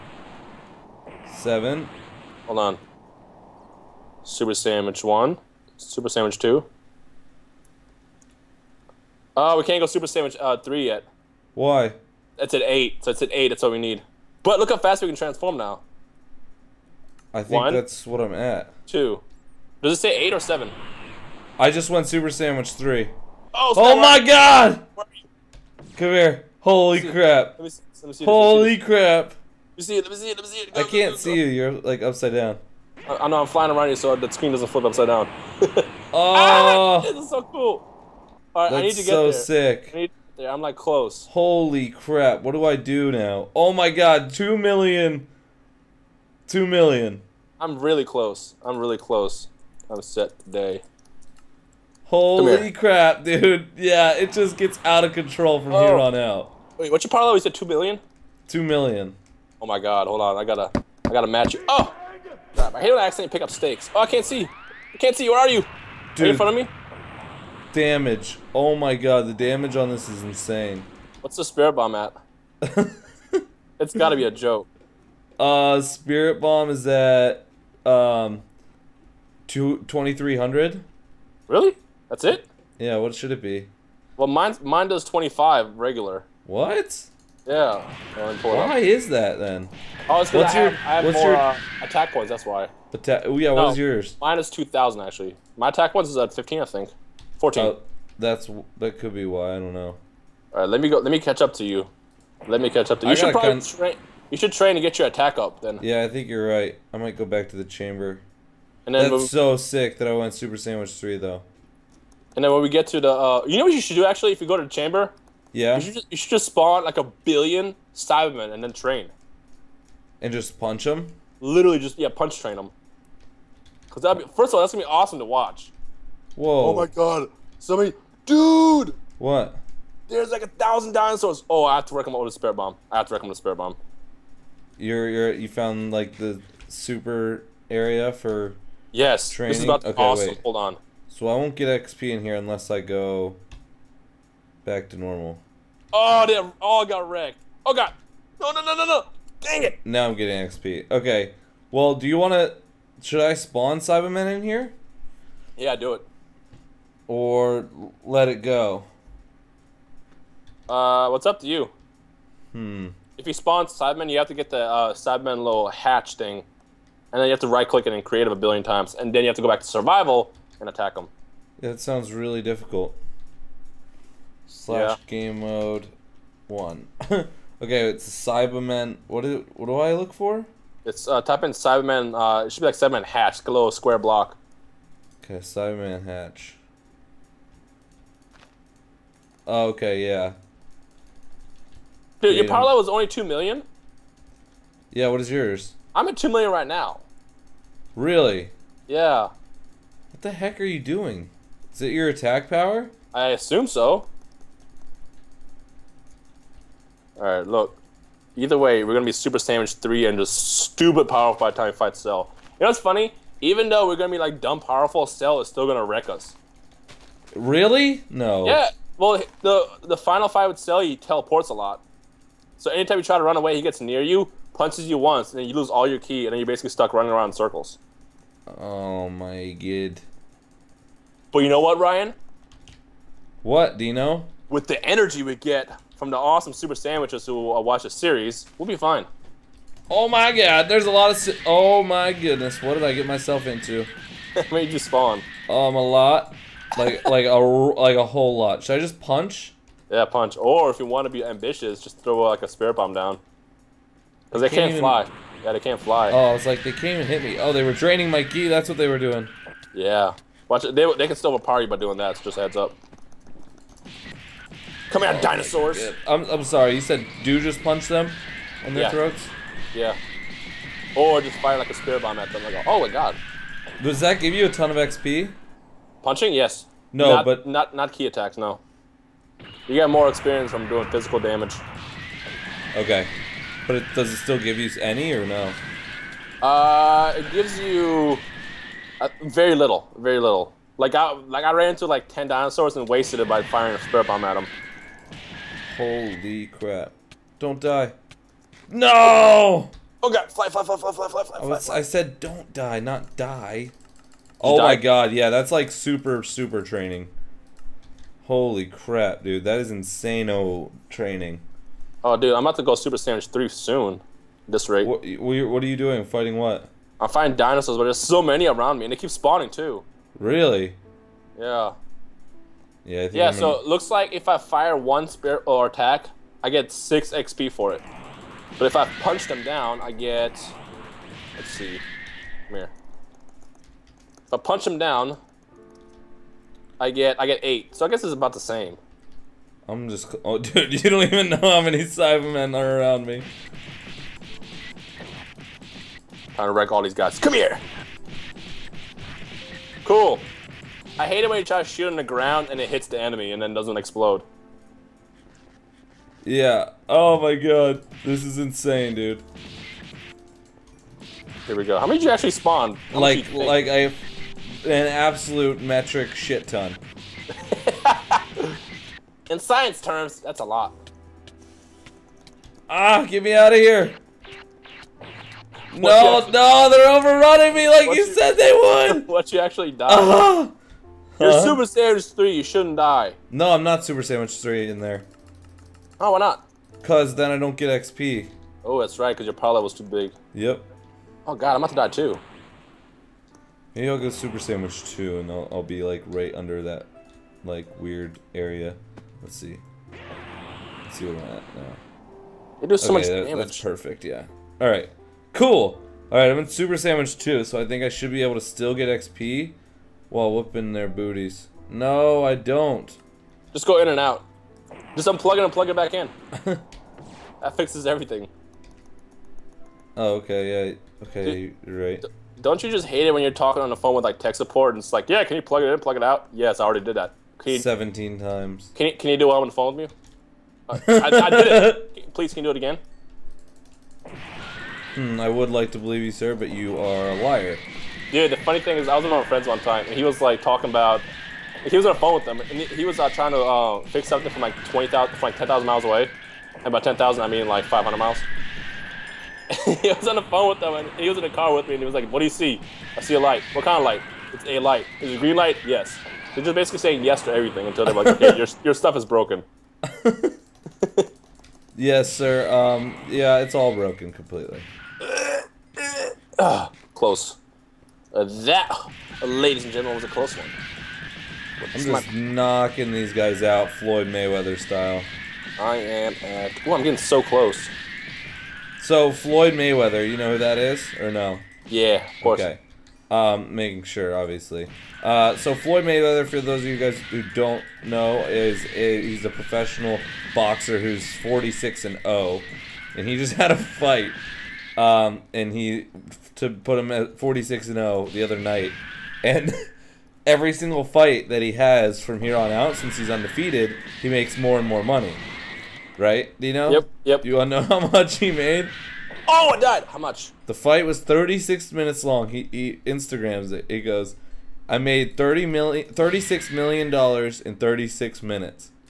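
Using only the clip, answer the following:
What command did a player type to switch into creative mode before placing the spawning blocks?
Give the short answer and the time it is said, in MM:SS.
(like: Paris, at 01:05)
game mode one, at 02:55.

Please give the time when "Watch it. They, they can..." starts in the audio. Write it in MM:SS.
04:20.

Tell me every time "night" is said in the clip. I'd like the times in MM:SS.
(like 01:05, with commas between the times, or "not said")
08:18.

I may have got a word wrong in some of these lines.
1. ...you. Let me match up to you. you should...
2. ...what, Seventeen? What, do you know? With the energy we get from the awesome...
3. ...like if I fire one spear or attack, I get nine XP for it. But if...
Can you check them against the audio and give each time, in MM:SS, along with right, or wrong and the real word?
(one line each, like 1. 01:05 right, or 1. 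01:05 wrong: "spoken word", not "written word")
1. 01:41 wrong: "catch", not "match"
2. 03:51 wrong: "Ryan", not "Seventeen"
3. 05:23 wrong: "six", not "nine".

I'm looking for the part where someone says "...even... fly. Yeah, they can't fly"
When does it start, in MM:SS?
04:14.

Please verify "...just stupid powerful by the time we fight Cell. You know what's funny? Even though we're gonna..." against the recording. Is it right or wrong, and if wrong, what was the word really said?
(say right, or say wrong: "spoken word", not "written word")
right.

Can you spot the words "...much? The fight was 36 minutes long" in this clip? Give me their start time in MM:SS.
08:29.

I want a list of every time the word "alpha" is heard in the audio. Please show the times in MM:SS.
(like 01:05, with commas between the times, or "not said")
not said.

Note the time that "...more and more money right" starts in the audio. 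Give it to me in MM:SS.
08:24.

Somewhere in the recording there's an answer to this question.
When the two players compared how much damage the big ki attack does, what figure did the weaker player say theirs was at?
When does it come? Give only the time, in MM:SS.
01:19.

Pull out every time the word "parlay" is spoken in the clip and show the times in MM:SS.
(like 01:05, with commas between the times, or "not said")
00:57, 03:12.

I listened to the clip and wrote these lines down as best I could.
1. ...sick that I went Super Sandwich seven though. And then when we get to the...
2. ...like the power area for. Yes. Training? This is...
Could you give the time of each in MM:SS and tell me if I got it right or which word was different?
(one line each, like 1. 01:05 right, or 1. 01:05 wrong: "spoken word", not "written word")
1. 01:49 wrong: "three", not "seven"
2. 02:15 wrong: "super", not "power".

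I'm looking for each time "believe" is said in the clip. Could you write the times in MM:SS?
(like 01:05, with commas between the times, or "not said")
07:15.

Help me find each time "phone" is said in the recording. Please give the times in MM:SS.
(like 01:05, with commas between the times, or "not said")
07:03, 07:09, 07:21, 07:30.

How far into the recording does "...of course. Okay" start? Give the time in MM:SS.
08:02.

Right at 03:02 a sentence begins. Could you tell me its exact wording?
Uh, it should be like Saibaman hatch, like a little square block.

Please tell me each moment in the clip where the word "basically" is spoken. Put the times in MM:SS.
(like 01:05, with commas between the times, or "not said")
03:46, 07:36.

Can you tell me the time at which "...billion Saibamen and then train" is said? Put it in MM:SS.
01:57.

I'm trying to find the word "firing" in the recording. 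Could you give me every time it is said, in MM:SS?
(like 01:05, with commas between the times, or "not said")
04:53.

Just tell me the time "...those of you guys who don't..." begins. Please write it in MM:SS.
08:06.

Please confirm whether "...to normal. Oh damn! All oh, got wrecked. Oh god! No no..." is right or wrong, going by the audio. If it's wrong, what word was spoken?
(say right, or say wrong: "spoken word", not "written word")
right.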